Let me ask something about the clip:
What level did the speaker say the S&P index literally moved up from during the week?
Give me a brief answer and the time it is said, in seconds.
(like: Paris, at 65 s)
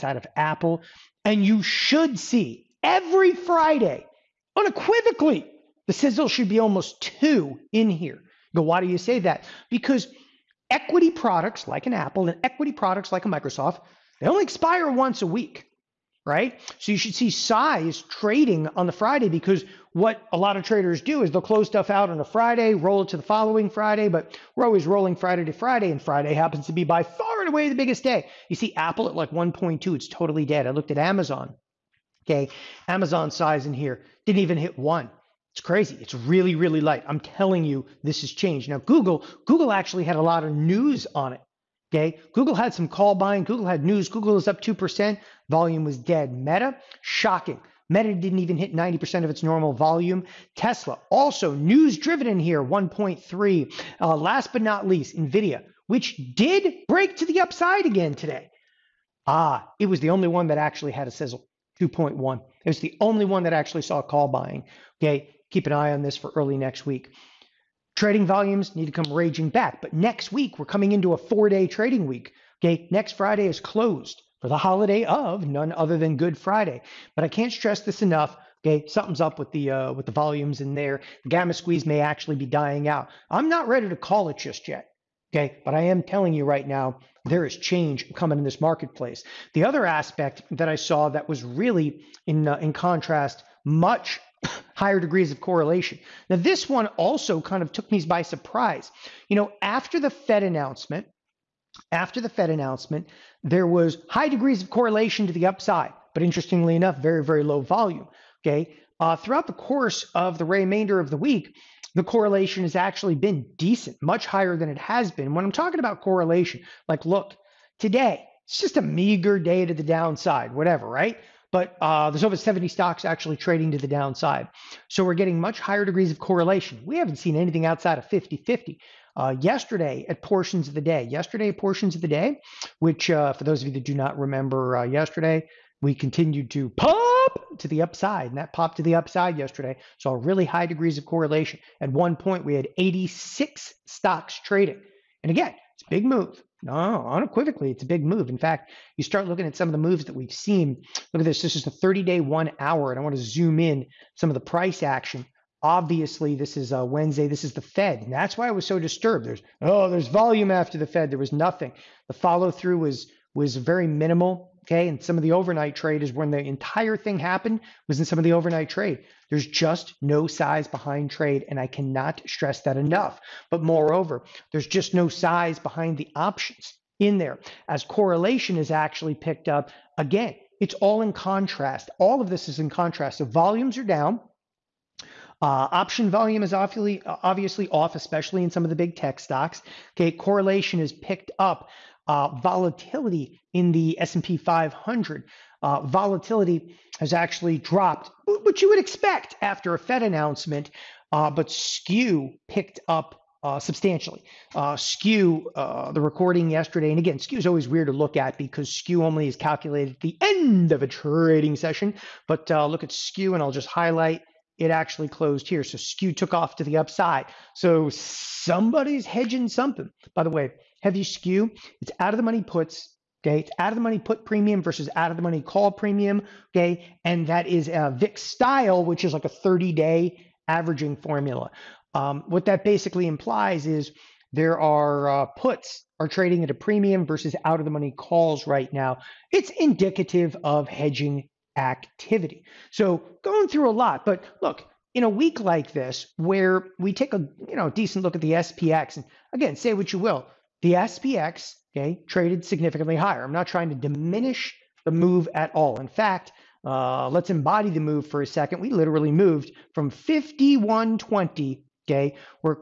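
5120, at 259 s.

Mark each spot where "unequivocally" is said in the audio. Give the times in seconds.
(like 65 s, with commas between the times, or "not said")
4 s, 147 s.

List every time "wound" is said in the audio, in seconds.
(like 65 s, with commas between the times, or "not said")
not said.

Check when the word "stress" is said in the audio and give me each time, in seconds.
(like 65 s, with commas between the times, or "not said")
77 s, 172 s.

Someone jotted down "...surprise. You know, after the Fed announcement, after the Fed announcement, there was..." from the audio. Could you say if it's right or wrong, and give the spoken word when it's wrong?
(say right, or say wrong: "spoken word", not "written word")
right.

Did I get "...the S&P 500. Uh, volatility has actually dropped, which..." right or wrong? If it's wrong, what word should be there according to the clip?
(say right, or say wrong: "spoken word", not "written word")
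right.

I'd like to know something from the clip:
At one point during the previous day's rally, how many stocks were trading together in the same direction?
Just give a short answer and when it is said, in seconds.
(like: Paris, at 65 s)
86, at 142 s.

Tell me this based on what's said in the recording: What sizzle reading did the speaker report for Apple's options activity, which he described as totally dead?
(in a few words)
1.2.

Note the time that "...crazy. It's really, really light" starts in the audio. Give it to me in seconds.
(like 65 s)
35 s.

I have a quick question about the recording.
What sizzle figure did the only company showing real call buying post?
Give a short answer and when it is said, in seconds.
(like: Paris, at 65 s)
2.1, at 61 s.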